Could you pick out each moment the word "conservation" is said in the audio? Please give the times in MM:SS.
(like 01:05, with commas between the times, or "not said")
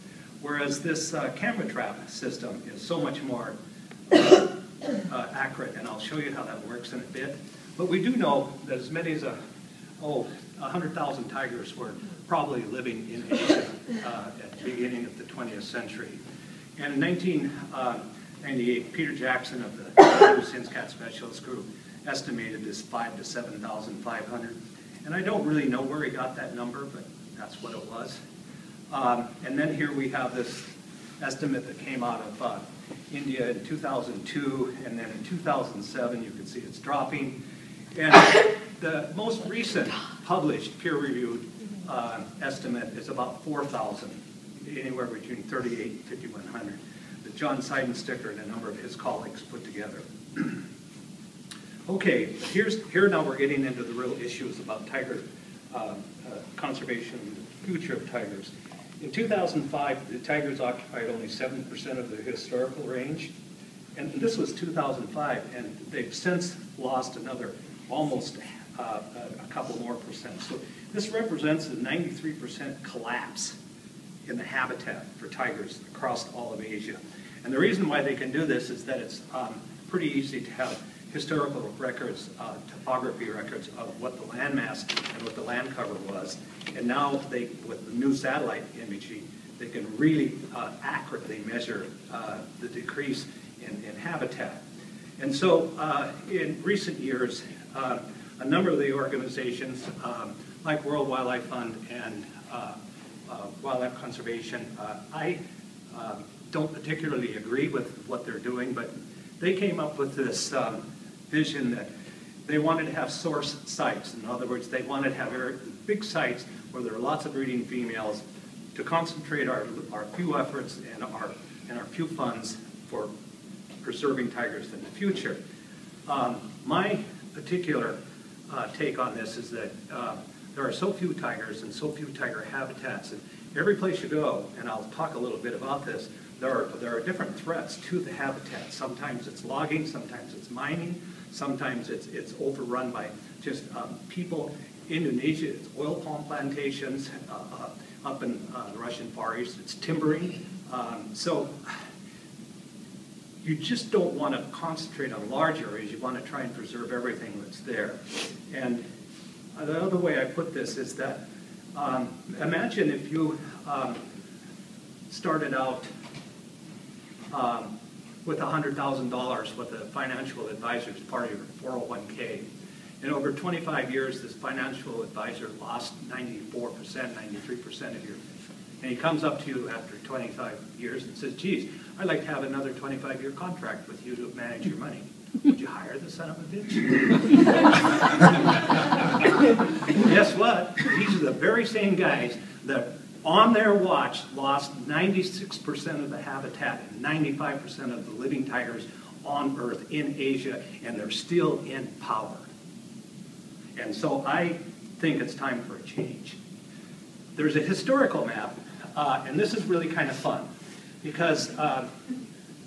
00:56, 01:43.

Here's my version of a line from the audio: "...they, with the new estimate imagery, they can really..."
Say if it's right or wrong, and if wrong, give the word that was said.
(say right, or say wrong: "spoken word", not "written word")
wrong: "satellite", not "estimate".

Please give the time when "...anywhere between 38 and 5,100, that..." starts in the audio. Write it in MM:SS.
00:44.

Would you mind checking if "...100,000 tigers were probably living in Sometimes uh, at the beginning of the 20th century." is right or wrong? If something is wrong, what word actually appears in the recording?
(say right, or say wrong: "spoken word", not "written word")
wrong: "Asia", not "Sometimes".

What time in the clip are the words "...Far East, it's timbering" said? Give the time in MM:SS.
02:29.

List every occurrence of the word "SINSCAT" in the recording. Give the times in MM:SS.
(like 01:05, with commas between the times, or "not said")
00:20.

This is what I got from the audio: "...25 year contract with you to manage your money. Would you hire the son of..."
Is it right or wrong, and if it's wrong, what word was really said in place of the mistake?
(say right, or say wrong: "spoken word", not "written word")
right.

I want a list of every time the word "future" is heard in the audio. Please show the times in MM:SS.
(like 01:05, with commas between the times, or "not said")
00:57, 02:04.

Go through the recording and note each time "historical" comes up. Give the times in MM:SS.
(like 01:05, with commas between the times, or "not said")
01:02, 01:21, 03:27.